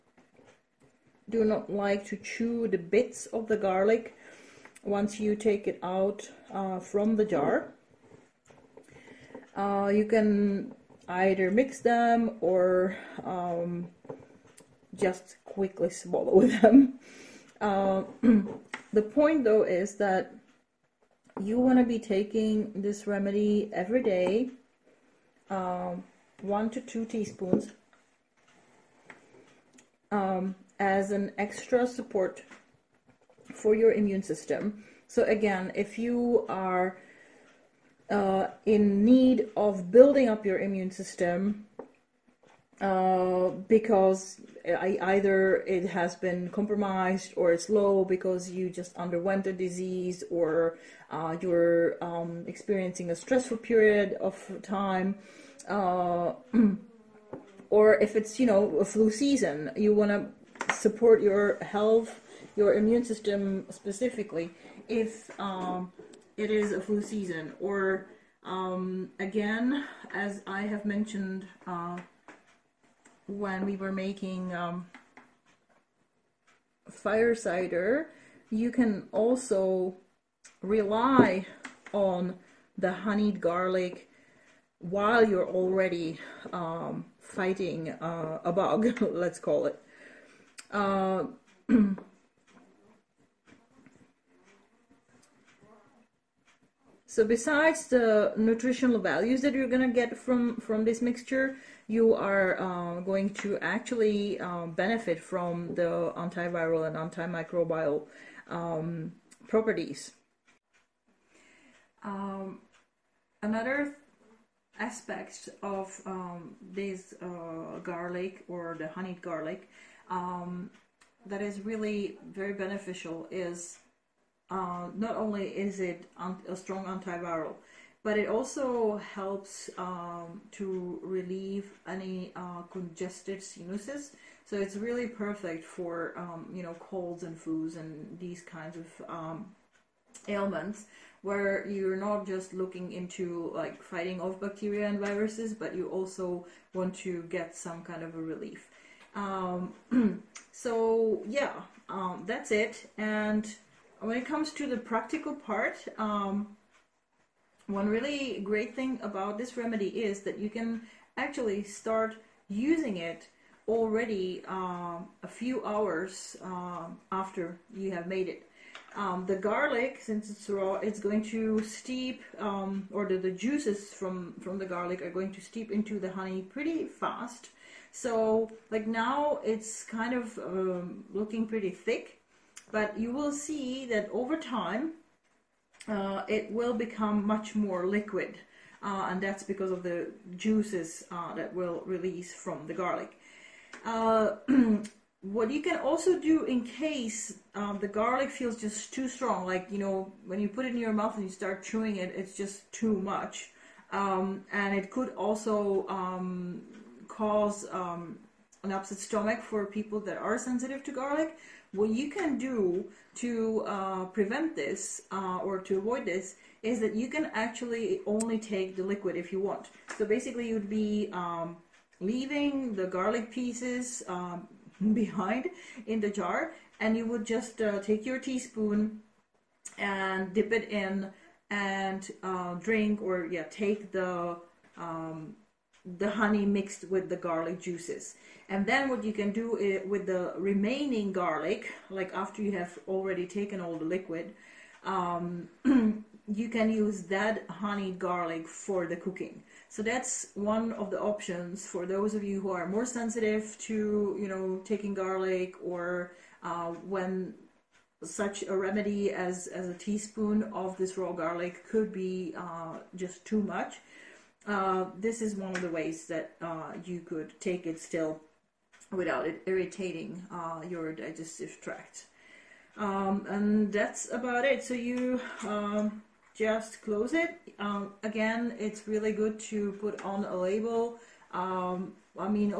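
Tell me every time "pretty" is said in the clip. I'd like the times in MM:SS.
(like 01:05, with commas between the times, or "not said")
02:56, 03:01.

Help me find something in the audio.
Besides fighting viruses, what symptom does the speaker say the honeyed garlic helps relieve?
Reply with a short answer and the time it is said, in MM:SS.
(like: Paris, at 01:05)
congested sinuses, at 02:12.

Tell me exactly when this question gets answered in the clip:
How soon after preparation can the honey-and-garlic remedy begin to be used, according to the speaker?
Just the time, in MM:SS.
02:45.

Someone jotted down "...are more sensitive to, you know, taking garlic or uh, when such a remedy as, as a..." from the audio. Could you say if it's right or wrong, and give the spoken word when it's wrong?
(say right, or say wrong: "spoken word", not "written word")
right.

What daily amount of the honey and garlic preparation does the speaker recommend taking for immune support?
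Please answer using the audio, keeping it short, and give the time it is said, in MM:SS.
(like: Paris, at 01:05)
1 to 2 teaspoons, at 00:26.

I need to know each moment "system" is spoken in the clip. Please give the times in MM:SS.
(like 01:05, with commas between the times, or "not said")
00:34, 00:40, 01:03.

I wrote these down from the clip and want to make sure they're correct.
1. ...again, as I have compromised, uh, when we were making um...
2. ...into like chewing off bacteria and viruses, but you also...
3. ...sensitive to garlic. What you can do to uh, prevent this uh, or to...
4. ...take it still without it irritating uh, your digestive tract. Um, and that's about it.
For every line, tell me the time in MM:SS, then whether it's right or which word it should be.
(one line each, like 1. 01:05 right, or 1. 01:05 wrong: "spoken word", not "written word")
1. 01:09 wrong: "mentioned", not "compromised"
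2. 02:22 wrong: "fighting", not "chewing"
3. 03:30 right
4. 04:27 right.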